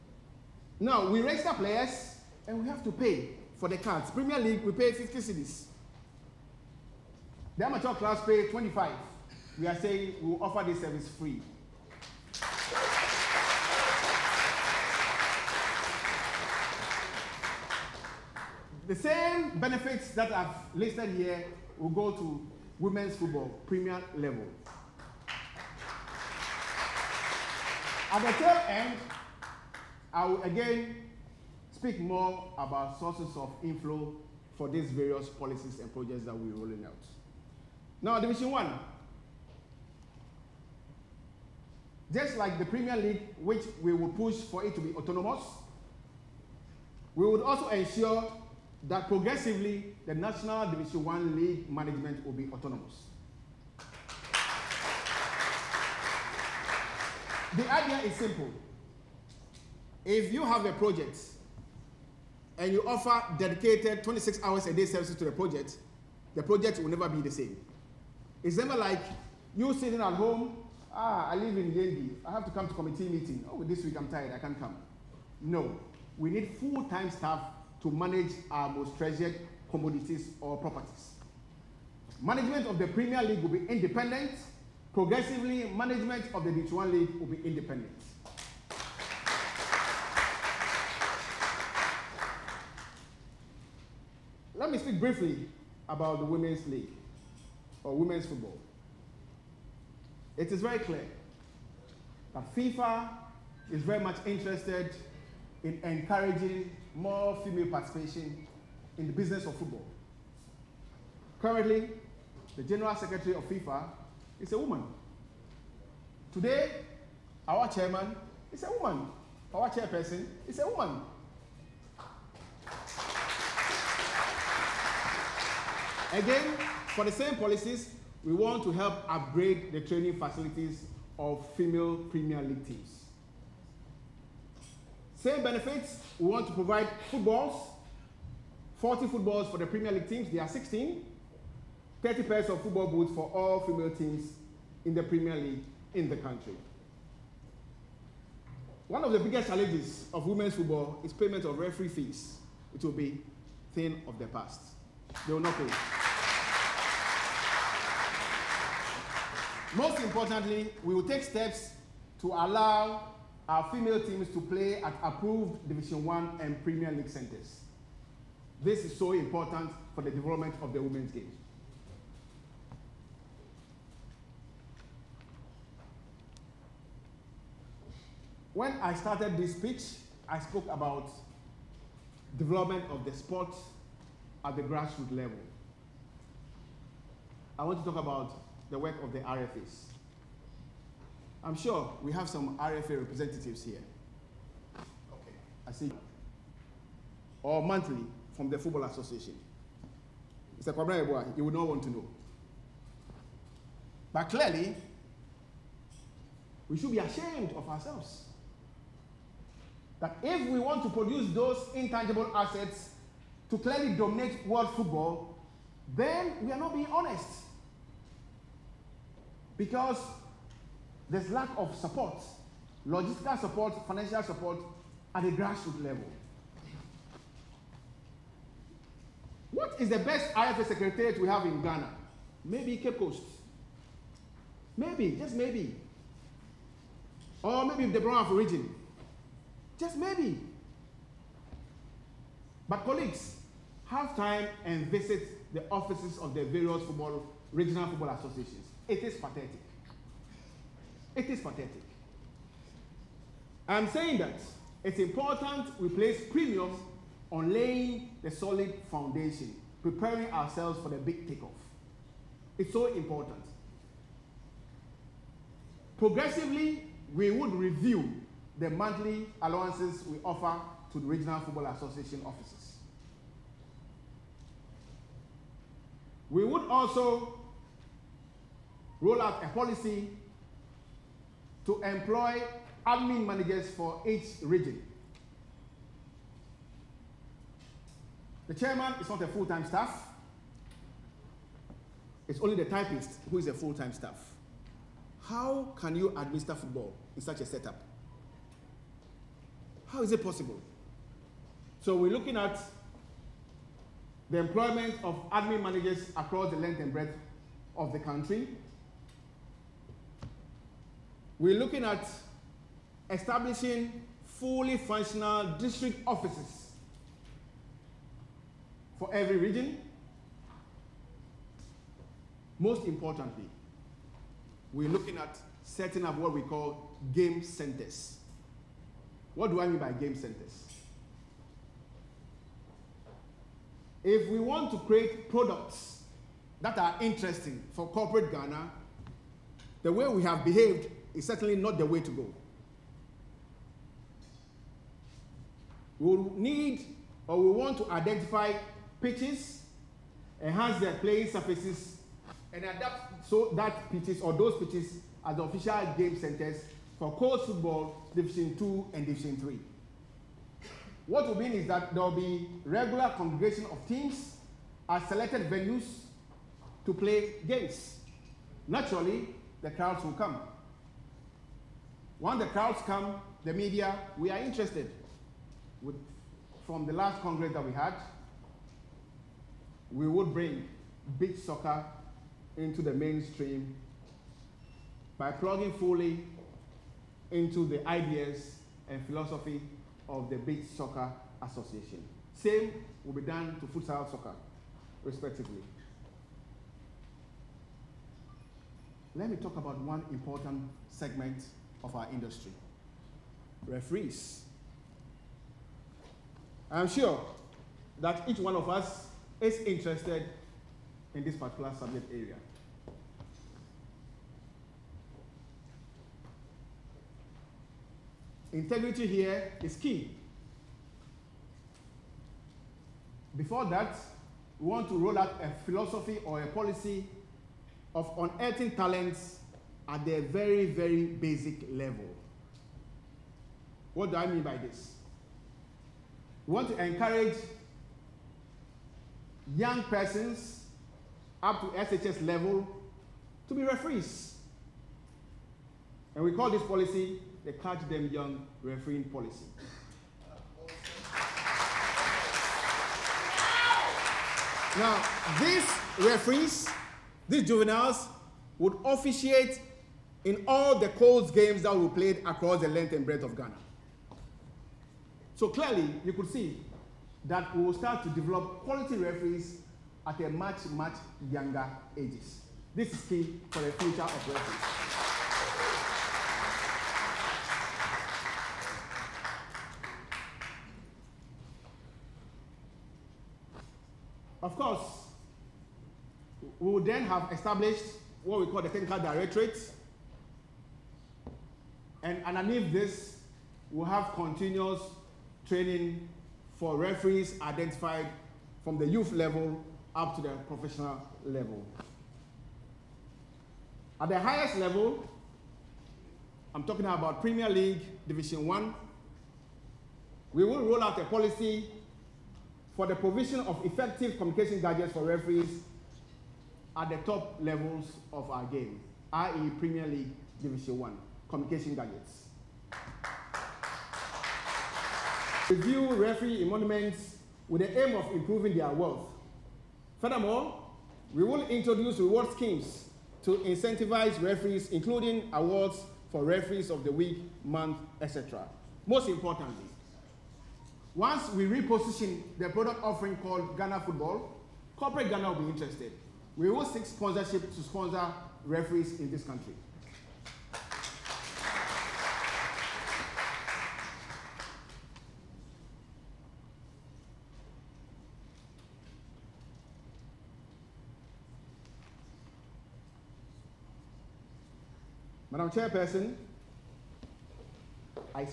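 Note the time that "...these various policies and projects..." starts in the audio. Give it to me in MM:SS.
00:34.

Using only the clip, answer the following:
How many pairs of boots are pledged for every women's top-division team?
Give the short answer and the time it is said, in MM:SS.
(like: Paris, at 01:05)
30, at 02:22.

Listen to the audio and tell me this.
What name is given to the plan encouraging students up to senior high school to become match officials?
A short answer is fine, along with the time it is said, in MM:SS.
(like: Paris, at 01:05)
Catch Them Young Refereeing Policy, at 07:27.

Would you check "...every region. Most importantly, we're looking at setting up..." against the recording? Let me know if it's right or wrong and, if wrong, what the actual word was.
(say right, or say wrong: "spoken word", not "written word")
right.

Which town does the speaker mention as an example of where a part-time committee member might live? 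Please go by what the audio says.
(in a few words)
Yendi.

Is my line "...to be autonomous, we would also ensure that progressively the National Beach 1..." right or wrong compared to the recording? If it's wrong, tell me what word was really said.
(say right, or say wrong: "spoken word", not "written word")
wrong: "Division", not "Beach".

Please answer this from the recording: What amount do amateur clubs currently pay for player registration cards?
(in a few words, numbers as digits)
25.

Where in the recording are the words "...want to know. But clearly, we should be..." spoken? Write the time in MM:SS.
03:21.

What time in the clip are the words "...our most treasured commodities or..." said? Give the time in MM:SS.
01:18.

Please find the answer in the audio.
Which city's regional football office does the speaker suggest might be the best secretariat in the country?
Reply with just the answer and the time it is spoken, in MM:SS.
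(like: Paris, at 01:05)
Cape Coast, at 03:52.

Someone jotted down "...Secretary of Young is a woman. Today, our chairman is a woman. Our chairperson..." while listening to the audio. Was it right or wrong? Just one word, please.
wrong.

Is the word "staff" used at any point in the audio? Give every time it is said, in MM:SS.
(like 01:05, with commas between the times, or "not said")
01:17, 04:49, 04:53.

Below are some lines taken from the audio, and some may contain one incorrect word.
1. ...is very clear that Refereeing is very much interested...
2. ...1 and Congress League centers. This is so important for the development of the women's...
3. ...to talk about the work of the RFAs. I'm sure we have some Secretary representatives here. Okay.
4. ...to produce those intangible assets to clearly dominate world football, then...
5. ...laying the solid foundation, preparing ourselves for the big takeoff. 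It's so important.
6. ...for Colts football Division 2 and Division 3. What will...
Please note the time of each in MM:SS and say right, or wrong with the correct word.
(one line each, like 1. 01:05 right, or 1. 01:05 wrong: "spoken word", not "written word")
1. 01:40 wrong: "FIFA", not "Refereeing"
2. 02:46 wrong: "Premier", not "Congress"
3. 03:07 wrong: "RFA", not "Secretary"
4. 03:30 right
5. 04:17 right
6. 05:56 right.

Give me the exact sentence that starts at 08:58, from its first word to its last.
Most importantly, once we reposition the product offering called Ghana Football, corporate Ghana will be interested.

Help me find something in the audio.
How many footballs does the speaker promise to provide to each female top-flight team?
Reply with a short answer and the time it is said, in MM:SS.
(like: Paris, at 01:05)
40, at 02:18.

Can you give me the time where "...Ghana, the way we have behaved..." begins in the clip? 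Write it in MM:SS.
05:38.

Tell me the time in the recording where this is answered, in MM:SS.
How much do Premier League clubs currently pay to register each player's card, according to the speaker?
00:04.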